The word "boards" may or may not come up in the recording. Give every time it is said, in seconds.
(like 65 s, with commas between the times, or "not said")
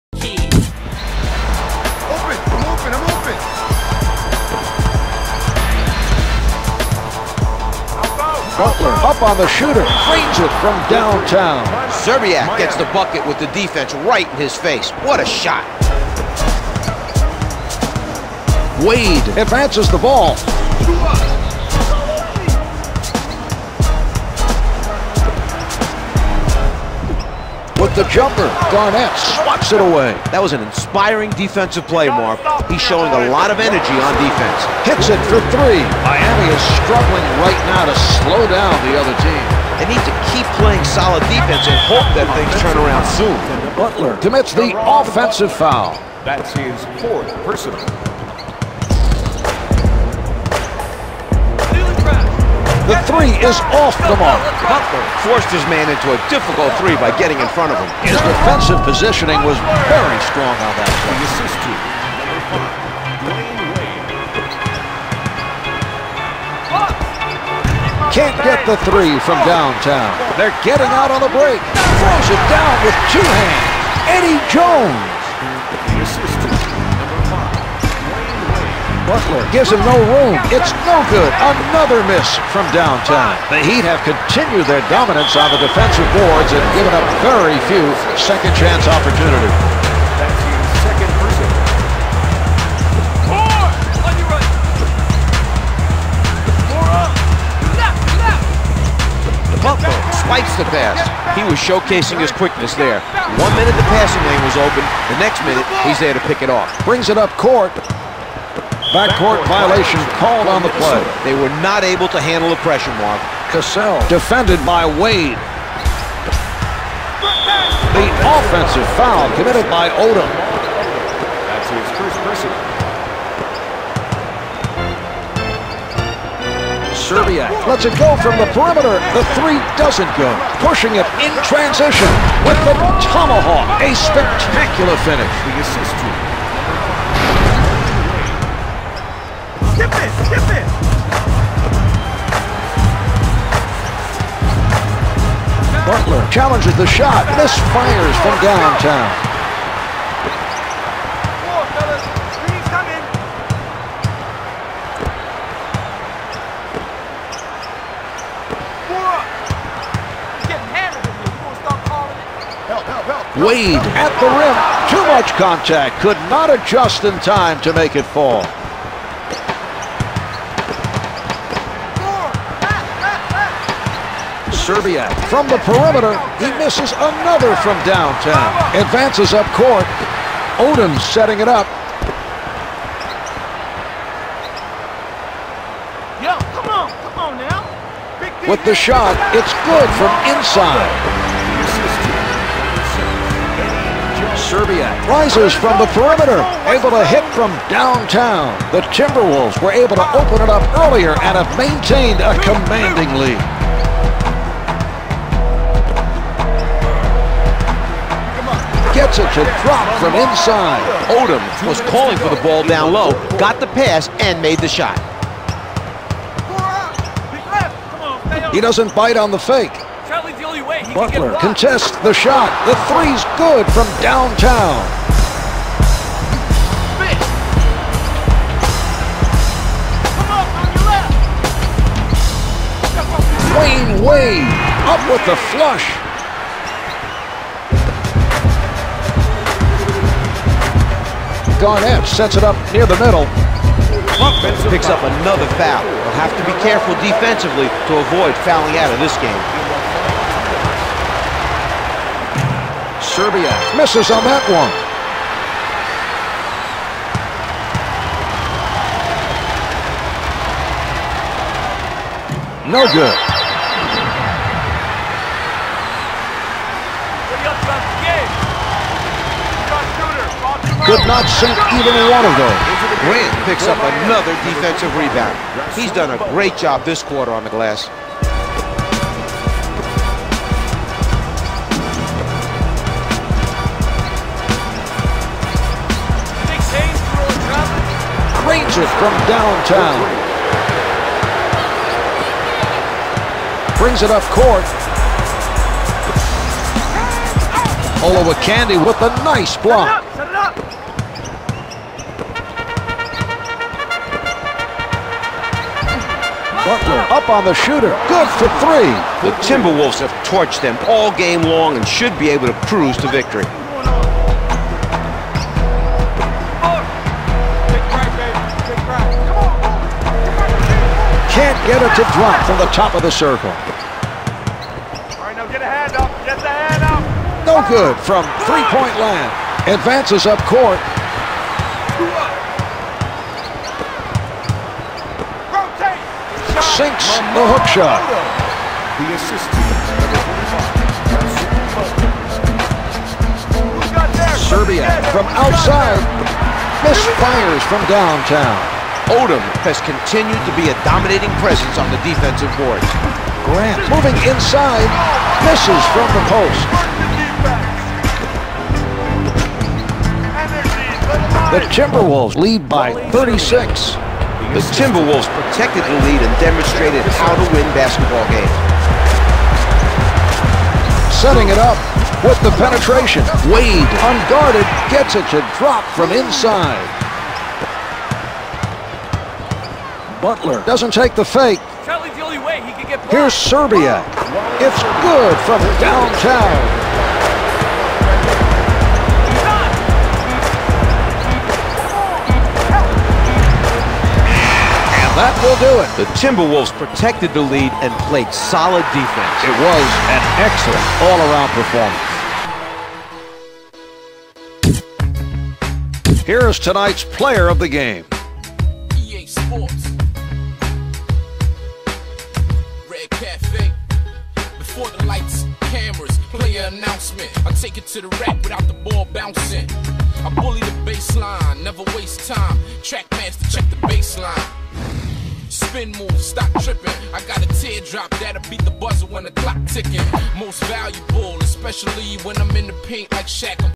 86 s, 352 s.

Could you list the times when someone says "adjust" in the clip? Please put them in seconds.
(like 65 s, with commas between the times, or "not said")
166 s.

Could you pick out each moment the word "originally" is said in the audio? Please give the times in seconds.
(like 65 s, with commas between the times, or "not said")
not said.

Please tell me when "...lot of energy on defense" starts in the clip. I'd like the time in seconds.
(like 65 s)
33 s.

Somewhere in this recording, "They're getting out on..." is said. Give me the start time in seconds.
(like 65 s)
70 s.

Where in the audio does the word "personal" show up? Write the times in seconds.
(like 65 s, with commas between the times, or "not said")
47 s, 122 s.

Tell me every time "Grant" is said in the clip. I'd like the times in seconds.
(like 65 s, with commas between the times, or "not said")
273 s, 353 s.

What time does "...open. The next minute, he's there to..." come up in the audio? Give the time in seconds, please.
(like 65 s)
104 s.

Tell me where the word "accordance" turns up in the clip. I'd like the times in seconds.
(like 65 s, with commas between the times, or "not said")
not said.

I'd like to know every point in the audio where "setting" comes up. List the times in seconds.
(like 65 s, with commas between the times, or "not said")
181 s, 371 s.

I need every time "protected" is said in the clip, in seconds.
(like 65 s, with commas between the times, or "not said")
365 s, 396 s.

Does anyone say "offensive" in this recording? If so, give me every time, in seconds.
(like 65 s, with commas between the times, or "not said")
44 s, 118 s.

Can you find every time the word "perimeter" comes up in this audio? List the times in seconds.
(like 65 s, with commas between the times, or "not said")
128 s, 175 s, 195 s.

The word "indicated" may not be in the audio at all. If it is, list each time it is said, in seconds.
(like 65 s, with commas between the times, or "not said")
not said.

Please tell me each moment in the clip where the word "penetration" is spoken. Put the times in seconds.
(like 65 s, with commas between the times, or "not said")
372 s.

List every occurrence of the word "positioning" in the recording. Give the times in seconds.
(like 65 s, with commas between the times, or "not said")
58 s.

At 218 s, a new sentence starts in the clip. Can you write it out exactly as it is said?
He doesn't bite on the fake.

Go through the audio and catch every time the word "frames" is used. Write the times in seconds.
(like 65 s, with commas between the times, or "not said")
9 s.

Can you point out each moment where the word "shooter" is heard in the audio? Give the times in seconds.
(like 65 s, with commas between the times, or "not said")
9 s, 307 s.